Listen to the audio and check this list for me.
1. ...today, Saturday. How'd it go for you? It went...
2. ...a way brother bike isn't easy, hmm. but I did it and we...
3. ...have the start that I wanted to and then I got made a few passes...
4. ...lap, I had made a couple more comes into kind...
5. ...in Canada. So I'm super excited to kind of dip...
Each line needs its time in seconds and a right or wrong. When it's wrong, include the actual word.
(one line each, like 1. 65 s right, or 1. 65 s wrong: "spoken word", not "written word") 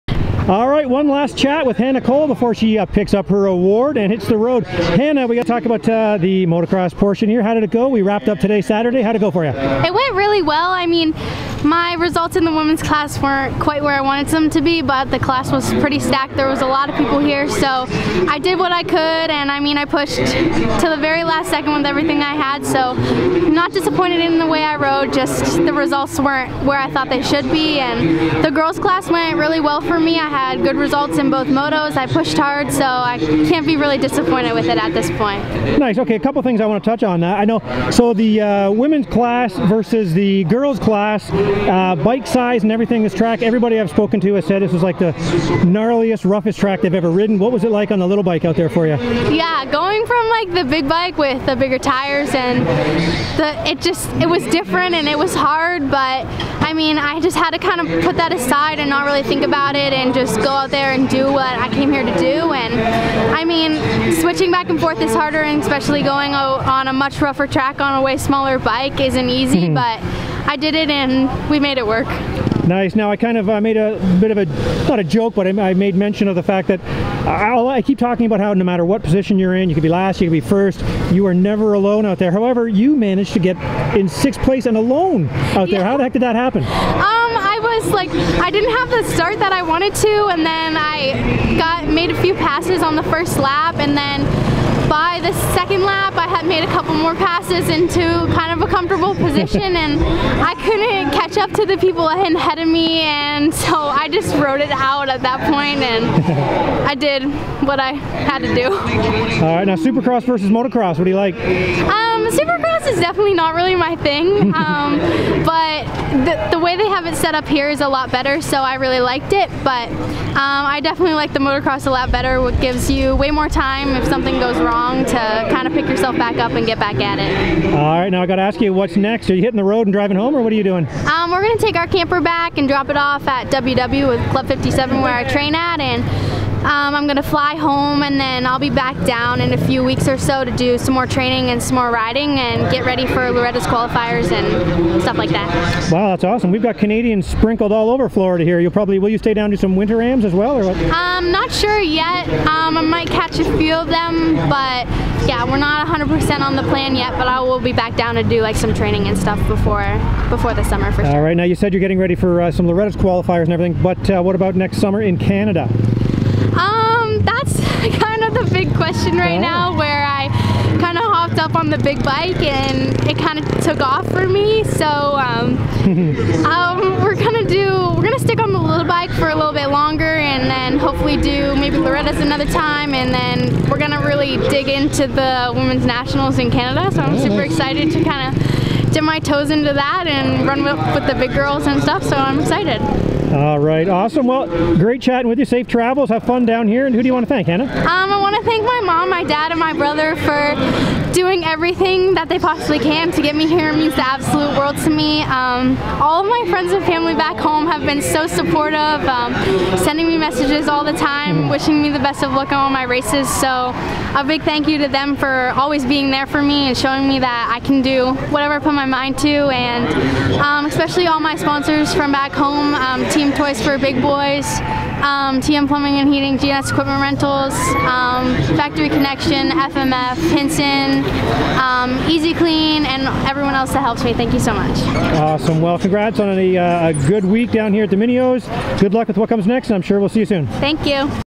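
1. 8 s right
2. 67 s wrong: "smaller", not "brother"
3. 88 s right
4. 95 s wrong: "passes", not "comes"
5. 186 s right.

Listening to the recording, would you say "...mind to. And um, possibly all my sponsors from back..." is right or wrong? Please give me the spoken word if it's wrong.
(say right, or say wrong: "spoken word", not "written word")
wrong: "especially", not "possibly".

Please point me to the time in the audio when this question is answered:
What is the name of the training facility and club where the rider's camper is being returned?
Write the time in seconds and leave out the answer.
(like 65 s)
134 s.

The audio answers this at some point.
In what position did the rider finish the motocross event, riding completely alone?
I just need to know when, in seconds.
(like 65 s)
84 s.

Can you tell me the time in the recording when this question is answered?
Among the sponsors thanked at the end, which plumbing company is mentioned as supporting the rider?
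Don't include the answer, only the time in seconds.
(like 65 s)
225 s.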